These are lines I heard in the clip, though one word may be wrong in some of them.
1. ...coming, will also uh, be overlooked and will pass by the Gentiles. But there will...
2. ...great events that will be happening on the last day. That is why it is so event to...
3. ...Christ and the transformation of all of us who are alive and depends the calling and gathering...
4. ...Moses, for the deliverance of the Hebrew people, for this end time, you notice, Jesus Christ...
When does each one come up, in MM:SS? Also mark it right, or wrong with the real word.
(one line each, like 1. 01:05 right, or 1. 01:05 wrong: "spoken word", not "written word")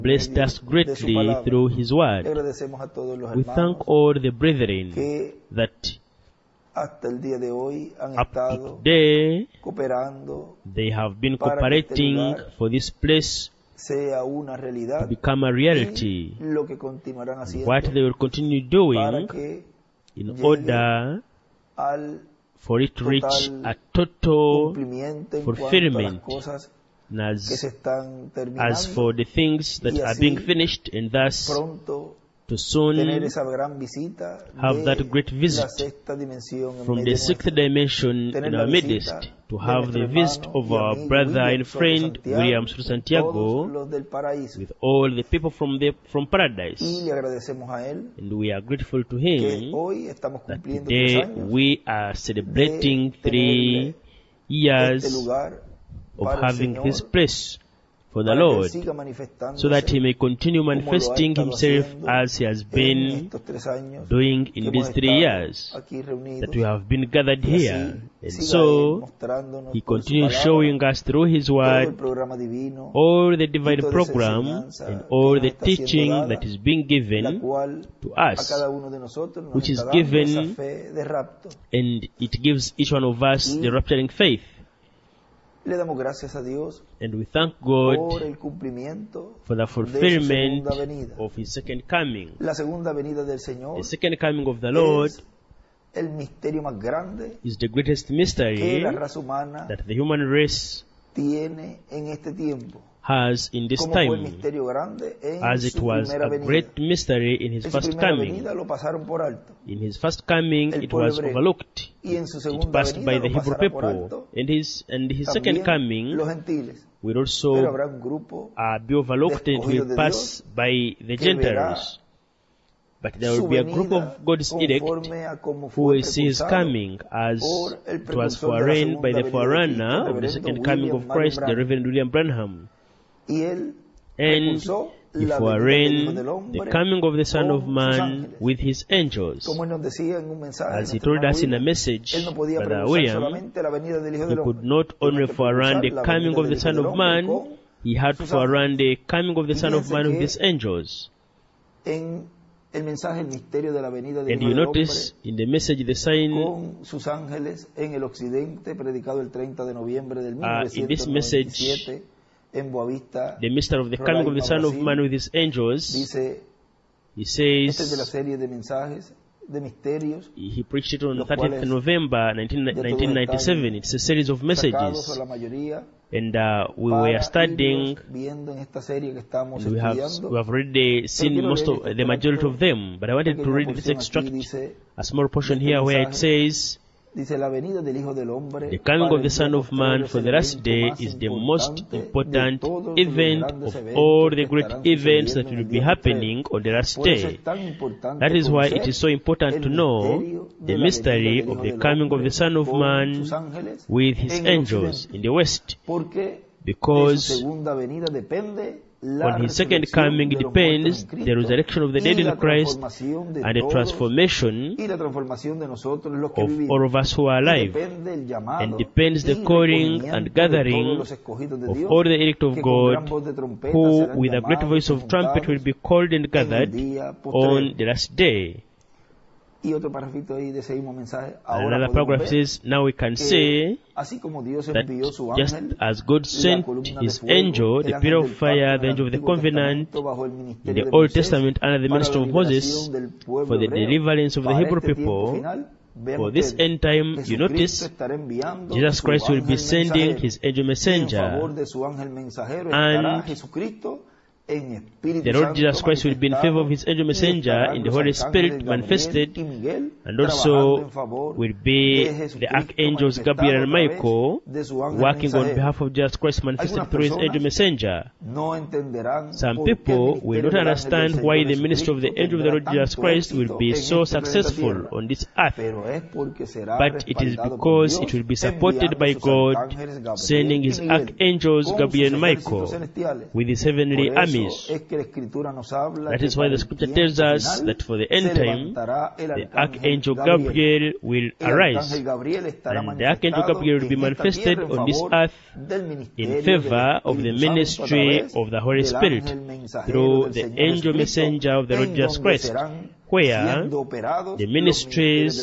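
1. 01:55 right
2. 03:14 wrong: "important", not "event"
3. 03:32 right
4. 04:02 right.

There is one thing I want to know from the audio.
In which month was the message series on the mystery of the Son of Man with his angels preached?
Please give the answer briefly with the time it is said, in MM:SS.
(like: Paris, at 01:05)
November, at 02:51.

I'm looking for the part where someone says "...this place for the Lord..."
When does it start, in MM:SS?
00:56.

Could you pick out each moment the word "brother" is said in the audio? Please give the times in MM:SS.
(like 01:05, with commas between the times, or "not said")
00:41, 02:22.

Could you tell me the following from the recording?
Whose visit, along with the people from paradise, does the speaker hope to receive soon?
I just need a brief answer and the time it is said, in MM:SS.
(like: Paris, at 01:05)
William Santiago, at 00:42.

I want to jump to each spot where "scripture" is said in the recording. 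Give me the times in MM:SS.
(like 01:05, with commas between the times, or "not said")
04:46.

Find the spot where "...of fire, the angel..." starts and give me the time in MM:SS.
03:58.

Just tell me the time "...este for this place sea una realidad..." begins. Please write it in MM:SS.
00:12.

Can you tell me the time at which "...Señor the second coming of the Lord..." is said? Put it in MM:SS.
01:33.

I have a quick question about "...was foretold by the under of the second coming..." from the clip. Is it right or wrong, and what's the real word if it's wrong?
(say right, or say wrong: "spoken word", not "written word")
wrong: "forerunner", not "under".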